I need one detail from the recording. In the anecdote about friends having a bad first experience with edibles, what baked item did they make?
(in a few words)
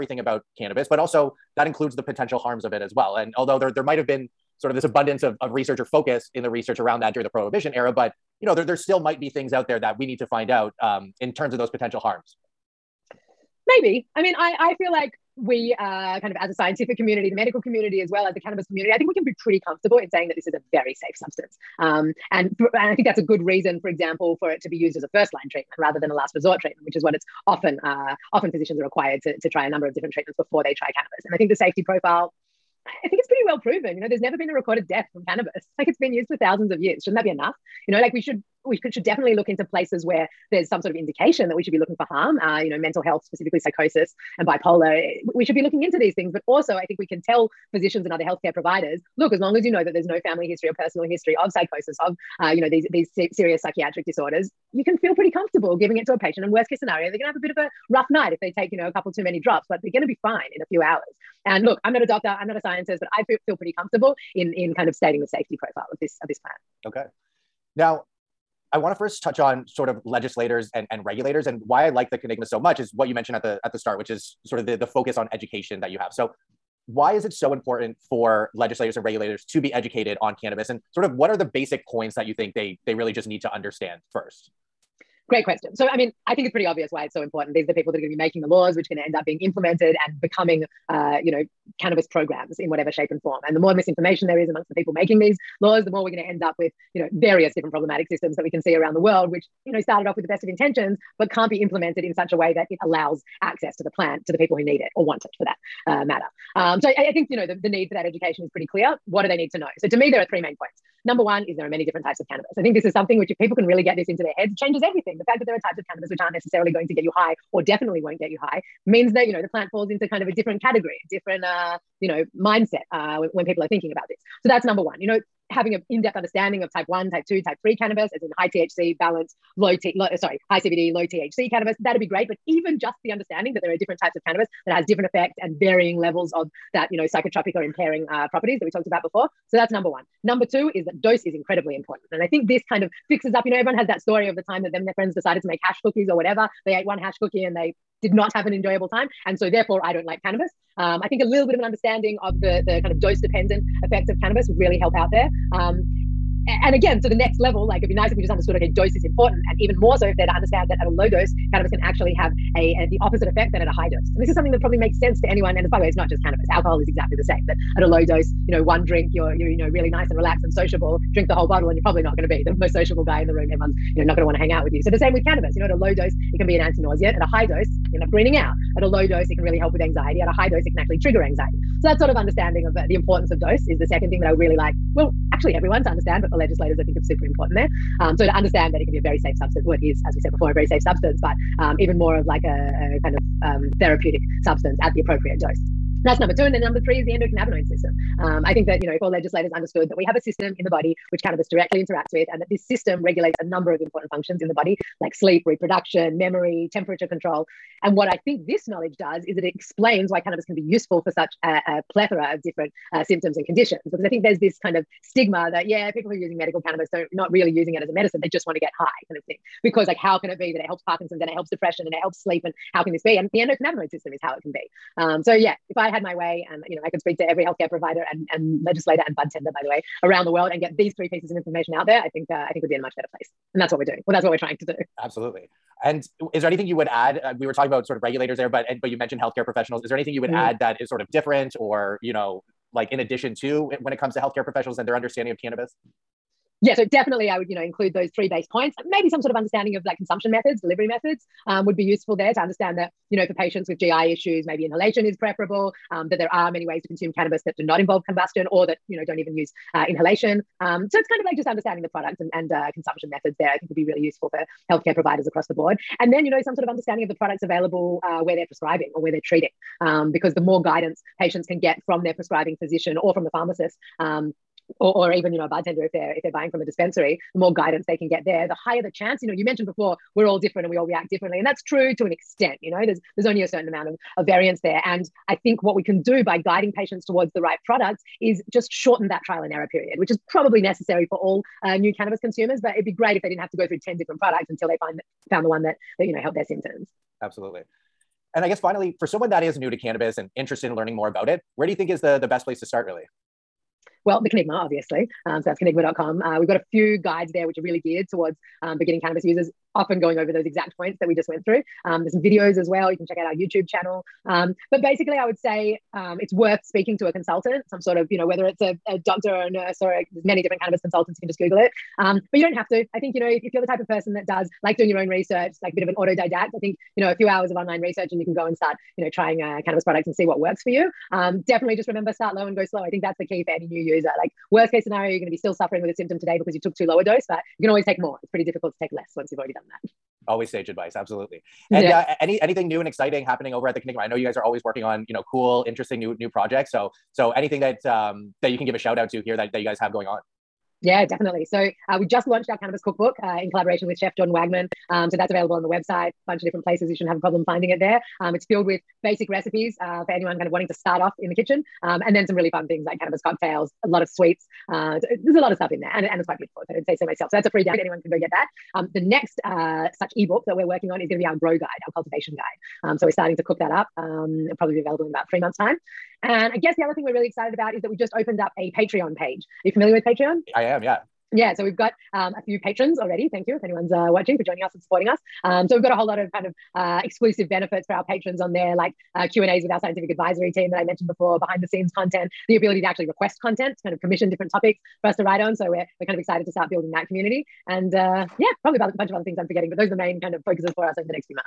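hash cookies.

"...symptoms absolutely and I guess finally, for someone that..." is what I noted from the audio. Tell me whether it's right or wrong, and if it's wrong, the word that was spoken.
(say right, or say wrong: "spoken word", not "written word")
right.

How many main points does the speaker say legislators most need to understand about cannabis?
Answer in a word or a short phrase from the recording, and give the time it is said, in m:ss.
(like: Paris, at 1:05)
3, at 1:50.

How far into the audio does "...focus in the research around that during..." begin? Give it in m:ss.
0:05.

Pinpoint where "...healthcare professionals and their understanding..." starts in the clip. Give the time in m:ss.
4:04.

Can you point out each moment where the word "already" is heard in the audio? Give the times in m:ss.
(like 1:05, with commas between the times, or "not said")
5:39, 6:22.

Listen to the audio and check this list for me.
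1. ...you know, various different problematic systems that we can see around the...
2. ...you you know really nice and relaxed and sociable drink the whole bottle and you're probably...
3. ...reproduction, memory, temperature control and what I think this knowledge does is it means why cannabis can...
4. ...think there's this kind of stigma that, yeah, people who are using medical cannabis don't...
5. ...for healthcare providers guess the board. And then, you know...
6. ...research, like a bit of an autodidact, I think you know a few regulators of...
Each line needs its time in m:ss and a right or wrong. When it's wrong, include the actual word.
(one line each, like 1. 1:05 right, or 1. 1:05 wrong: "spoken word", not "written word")
1. 1:36 right
2. 2:49 right
3. 3:25 wrong: "explains", not "means"
4. 3:34 right
5. 4:24 wrong: "across", not "guess"
6. 5:25 wrong: "hours", not "regulators".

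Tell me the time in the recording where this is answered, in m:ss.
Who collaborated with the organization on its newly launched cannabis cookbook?
5:53.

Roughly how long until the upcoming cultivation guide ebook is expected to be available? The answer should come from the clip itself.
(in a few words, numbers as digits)
about 3 months.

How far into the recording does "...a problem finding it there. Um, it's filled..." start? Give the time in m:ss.
5:57.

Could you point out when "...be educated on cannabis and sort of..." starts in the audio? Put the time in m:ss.
1:19.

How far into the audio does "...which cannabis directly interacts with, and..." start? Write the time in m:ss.
3:21.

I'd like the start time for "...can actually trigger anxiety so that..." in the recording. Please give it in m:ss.
3:00.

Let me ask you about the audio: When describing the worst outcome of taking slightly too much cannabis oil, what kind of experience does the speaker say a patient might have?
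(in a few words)
a bit of a rough night.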